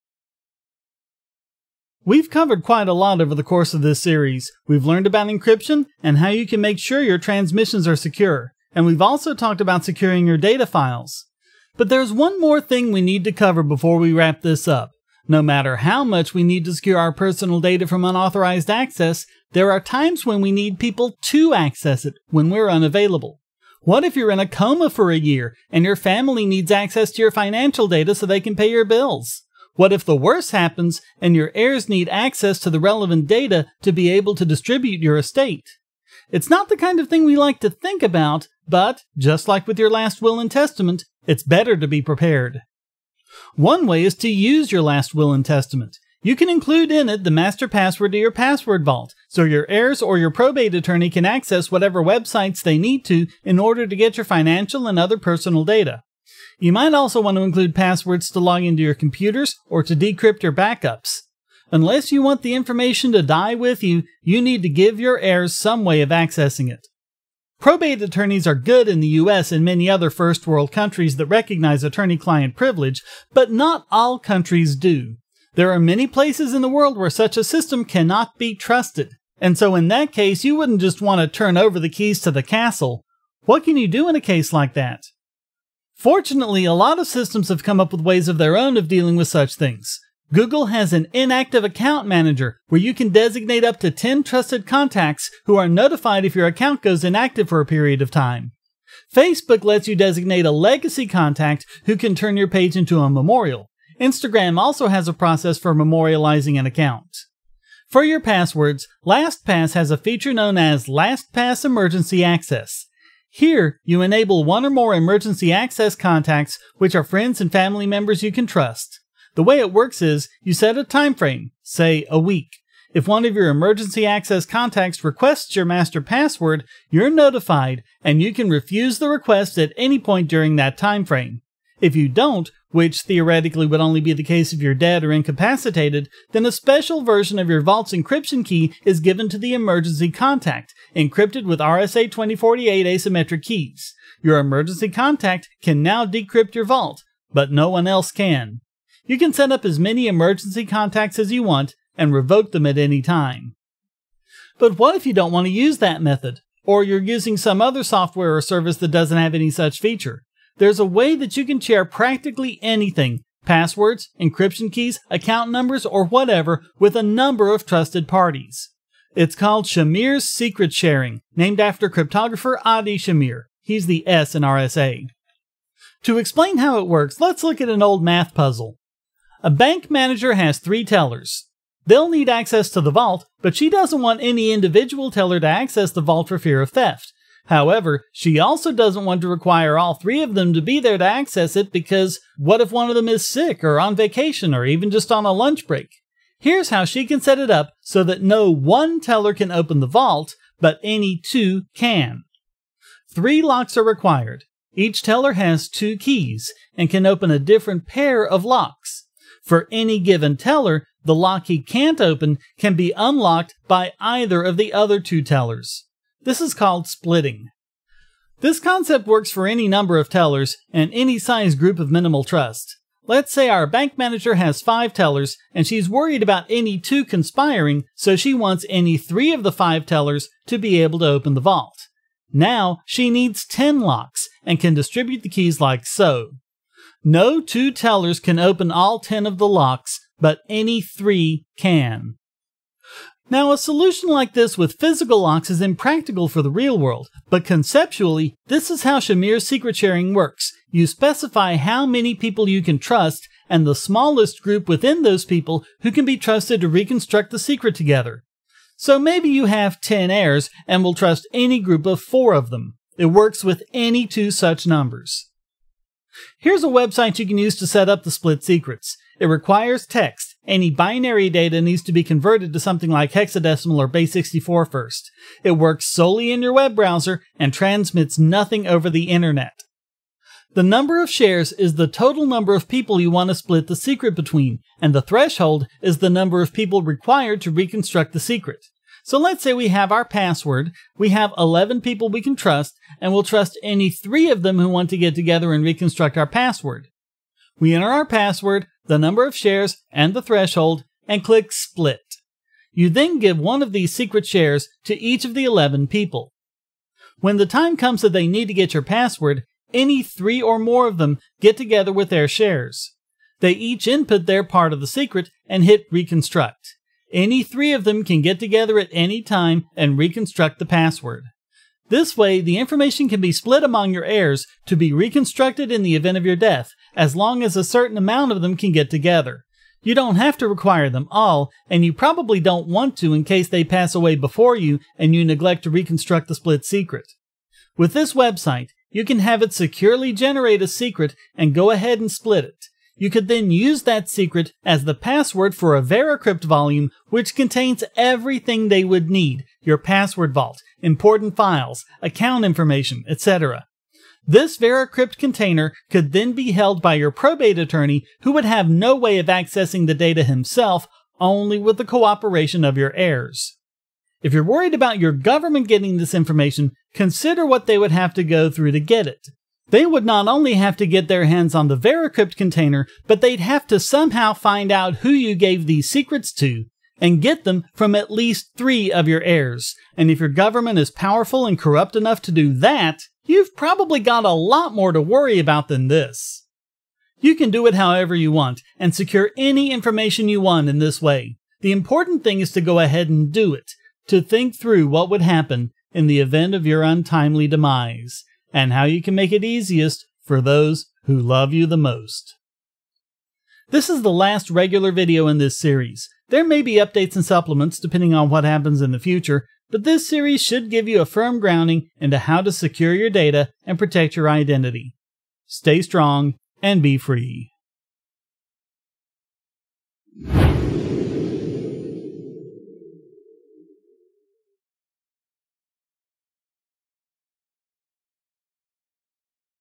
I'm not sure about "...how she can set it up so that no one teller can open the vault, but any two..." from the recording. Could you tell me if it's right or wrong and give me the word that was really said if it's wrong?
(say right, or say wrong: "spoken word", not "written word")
right.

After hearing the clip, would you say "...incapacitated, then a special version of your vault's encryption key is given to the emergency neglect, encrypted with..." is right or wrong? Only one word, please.
wrong.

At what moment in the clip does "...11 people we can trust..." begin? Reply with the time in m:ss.
4:51.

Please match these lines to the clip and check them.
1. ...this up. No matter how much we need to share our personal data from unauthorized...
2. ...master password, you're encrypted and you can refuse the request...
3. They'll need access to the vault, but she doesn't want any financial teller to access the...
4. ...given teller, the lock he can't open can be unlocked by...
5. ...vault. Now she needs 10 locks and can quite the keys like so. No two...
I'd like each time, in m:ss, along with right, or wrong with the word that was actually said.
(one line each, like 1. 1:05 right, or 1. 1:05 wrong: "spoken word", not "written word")
1. 0:14 wrong: "secure", not "share"
2. 2:05 wrong: "notified", not "encrypted"
3. 3:01 wrong: "individual", not "financial"
4. 3:29 right
5. 3:51 wrong: "distribute", not "quite".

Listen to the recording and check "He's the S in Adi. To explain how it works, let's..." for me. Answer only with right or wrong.
wrong.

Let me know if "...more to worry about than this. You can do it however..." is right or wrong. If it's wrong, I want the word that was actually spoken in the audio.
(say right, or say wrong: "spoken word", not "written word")
right.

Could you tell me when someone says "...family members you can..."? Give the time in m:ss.
1:57.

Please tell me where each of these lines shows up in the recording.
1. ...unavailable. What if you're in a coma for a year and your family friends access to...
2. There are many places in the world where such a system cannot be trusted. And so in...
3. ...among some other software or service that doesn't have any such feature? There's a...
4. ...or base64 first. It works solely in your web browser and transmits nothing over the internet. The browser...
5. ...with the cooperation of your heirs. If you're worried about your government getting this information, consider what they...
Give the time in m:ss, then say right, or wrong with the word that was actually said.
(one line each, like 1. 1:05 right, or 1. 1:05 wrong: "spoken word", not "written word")
1. 0:22 wrong: "needs", not "friends"
2. 1:15 right
3. 2:37 wrong: "using", not "among"
4. 4:33 wrong: "number", not "browser"
5. 6:01 right.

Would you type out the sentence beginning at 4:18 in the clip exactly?
So maybe you have 10 heirs and will trust any group of four of them.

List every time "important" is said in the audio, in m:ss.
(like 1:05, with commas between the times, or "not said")
5:50, 6:31.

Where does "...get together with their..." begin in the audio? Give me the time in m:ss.
5:11.